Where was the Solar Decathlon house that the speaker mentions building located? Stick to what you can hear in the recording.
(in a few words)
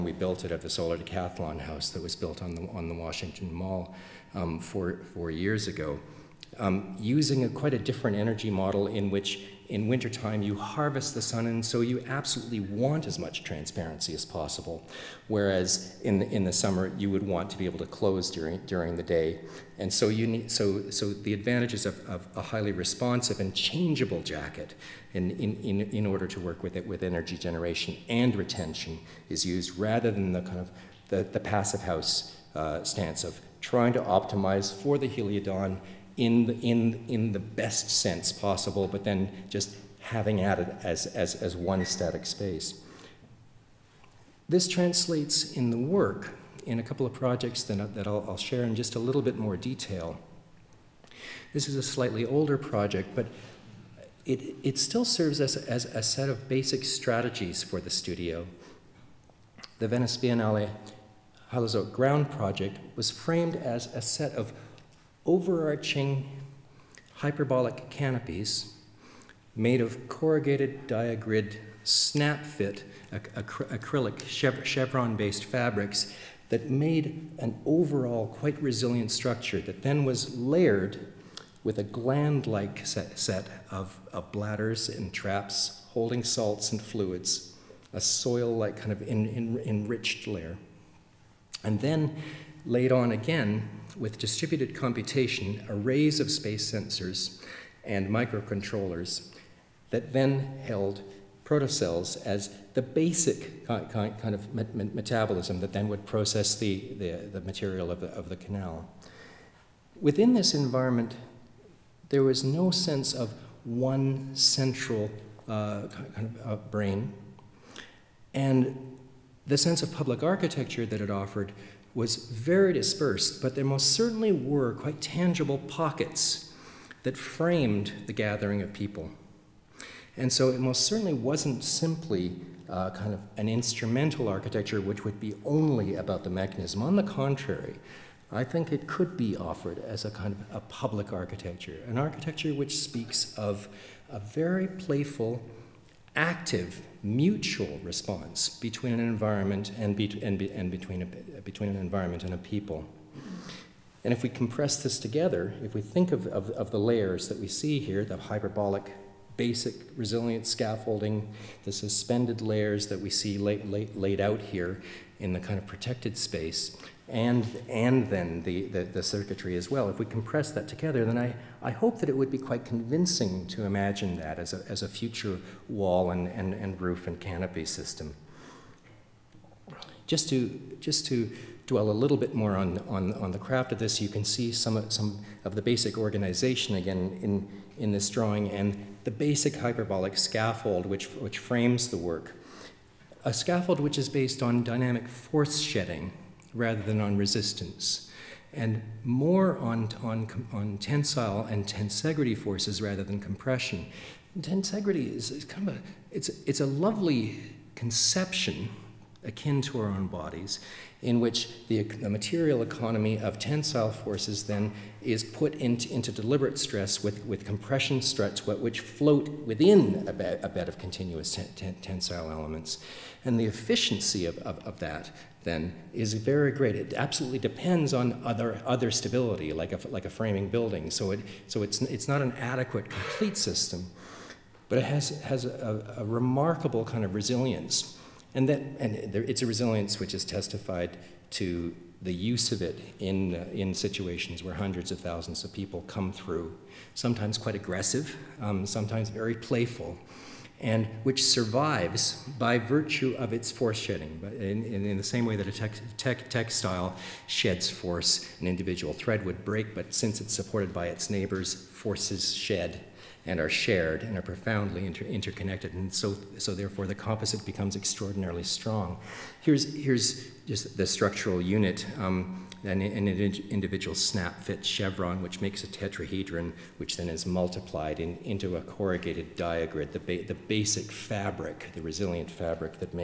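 Washington Mall.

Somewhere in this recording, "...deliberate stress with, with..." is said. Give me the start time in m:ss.
3:36.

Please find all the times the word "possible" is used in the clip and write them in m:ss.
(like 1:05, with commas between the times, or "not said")
0:14, 0:38.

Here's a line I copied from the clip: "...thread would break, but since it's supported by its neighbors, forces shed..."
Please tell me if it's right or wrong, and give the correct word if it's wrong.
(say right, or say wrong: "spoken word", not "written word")
right.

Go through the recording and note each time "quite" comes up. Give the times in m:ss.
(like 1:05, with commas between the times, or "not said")
0:07, 1:18, 2:04, 2:52, 4:07.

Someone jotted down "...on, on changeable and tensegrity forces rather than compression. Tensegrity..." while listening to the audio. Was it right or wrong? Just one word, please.
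wrong.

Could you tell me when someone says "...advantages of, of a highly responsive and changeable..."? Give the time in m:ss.
0:21.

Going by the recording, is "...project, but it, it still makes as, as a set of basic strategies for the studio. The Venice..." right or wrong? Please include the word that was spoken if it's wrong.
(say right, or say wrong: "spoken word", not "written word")
wrong: "serves", not "makes".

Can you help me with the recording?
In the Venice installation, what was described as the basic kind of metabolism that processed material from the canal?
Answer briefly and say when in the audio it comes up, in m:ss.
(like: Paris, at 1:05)
protocells, at 1:41.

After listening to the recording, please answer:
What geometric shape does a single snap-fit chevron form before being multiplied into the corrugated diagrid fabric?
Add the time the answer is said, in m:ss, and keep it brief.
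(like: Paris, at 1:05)
tetrahedron, at 4:35.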